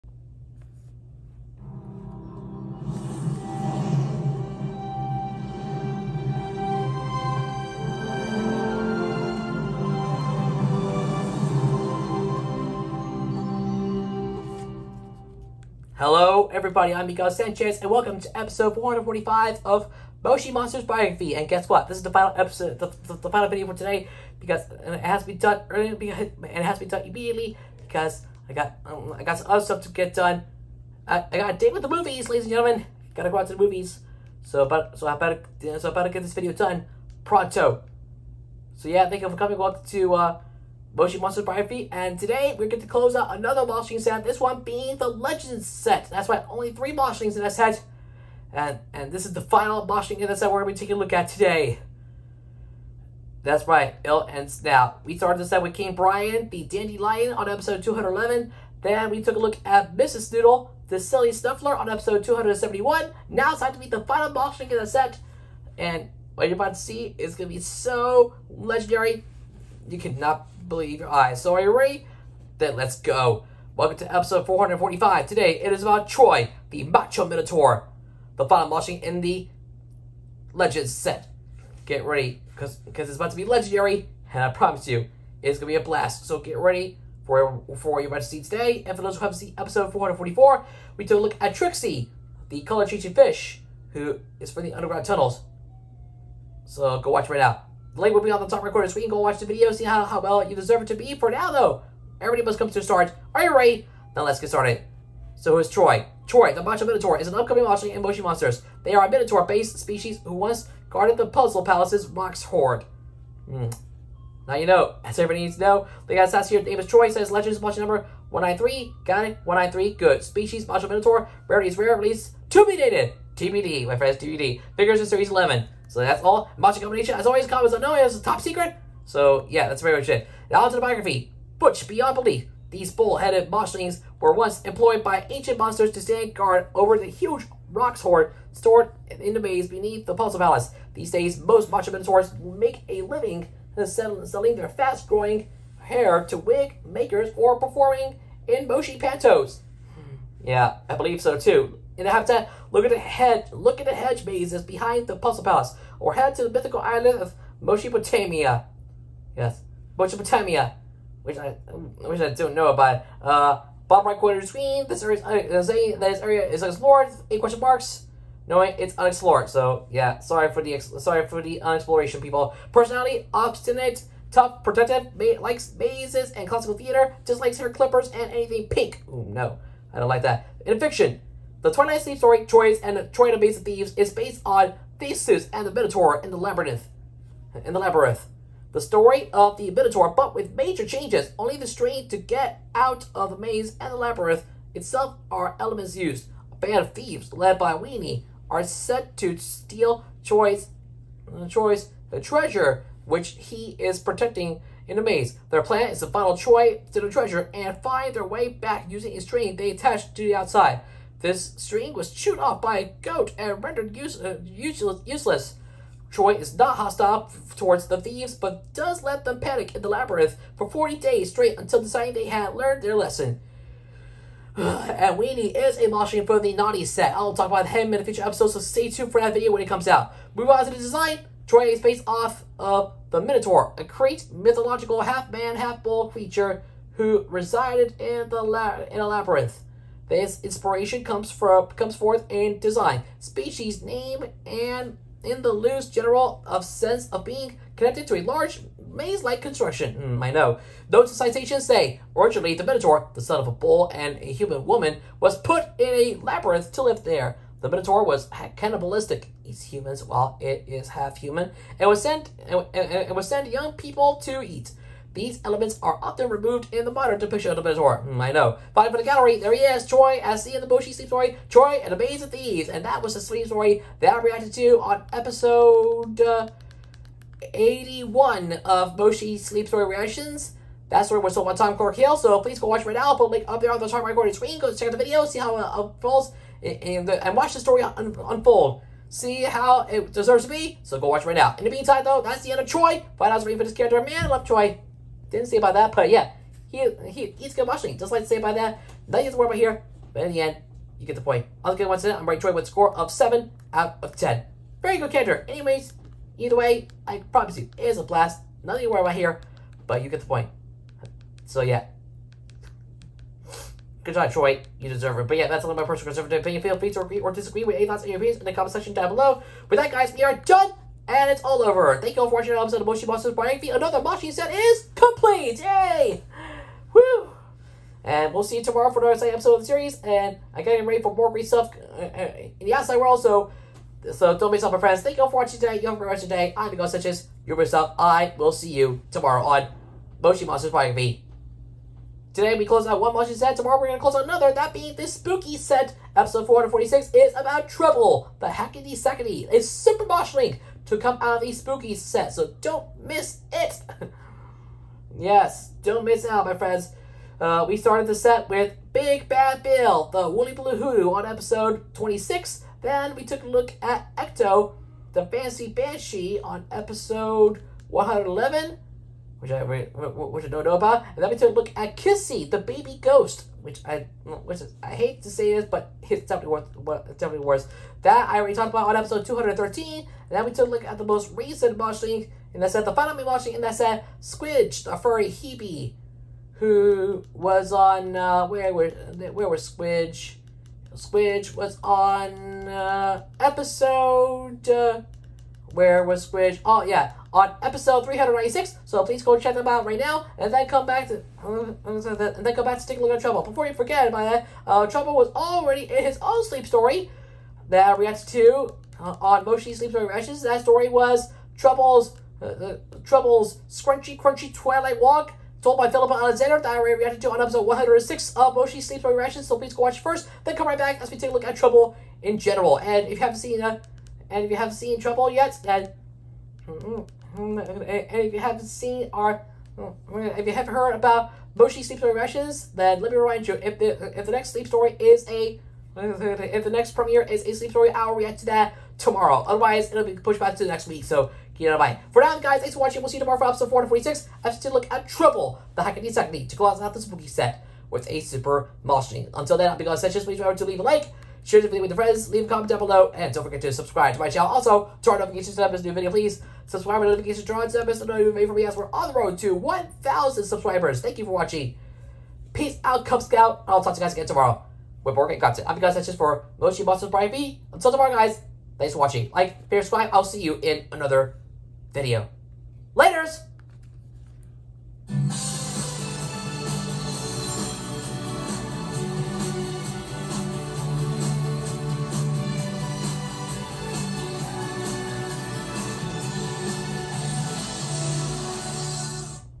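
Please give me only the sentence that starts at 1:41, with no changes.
For now, though, everybody must come to a start.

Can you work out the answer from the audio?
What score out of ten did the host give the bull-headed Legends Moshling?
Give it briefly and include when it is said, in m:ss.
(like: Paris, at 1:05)
7, at 5:03.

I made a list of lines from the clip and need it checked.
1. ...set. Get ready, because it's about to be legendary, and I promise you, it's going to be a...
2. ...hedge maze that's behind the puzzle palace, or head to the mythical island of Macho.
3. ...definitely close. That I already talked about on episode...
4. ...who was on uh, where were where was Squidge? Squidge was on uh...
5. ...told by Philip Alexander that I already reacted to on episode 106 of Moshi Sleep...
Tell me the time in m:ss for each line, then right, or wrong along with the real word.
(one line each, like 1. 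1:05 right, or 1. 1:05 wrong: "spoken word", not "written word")
1. 1:20 right
2. 2:33 wrong: "Mesopotamia", not "Macho"
3. 6:17 wrong: "worse", not "close"
4. 6:26 right
5. 6:55 right.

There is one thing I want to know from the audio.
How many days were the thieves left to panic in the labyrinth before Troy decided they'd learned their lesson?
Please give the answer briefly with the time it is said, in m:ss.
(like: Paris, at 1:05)
40, at 3:40.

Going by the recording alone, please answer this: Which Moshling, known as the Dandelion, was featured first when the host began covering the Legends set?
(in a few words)
King Brian.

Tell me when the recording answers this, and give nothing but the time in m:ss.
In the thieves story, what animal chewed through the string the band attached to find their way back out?
3:33.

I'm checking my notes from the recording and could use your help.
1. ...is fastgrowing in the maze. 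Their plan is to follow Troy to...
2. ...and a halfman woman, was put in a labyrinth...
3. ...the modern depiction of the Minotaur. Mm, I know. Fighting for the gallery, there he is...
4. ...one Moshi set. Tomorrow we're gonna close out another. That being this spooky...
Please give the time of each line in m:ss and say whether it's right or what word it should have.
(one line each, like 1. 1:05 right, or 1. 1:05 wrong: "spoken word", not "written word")
1. 3:23 wrong: "protecting", not "fastgrowing"
2. 4:13 wrong: "human", not "halfman"
3. 4:26 right
4. 5:43 right.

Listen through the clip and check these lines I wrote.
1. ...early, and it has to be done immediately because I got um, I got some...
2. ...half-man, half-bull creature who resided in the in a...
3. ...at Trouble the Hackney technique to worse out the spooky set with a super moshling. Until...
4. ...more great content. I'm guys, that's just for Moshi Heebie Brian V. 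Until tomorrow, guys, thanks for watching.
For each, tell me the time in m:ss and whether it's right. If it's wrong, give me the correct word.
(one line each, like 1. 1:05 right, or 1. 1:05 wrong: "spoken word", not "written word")
1. 0:25 right
2. 3:55 right
3. 7:24 wrong: "close", not "worse"
4. 7:45 wrong: "Monsters", not "Heebie".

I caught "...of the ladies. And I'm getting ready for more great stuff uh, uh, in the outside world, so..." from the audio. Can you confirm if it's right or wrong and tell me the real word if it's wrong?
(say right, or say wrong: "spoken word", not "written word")
wrong: "series", not "ladies".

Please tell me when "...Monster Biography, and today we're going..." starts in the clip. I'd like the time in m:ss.
0:41.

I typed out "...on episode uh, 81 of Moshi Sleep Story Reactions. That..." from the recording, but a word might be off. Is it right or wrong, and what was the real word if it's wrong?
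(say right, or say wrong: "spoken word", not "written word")
right.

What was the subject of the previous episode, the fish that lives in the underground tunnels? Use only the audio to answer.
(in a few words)
Trixie.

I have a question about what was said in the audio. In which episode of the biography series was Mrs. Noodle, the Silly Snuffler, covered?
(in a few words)
271.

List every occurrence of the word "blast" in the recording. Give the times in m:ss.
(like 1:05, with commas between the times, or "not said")
1:25, 5:08.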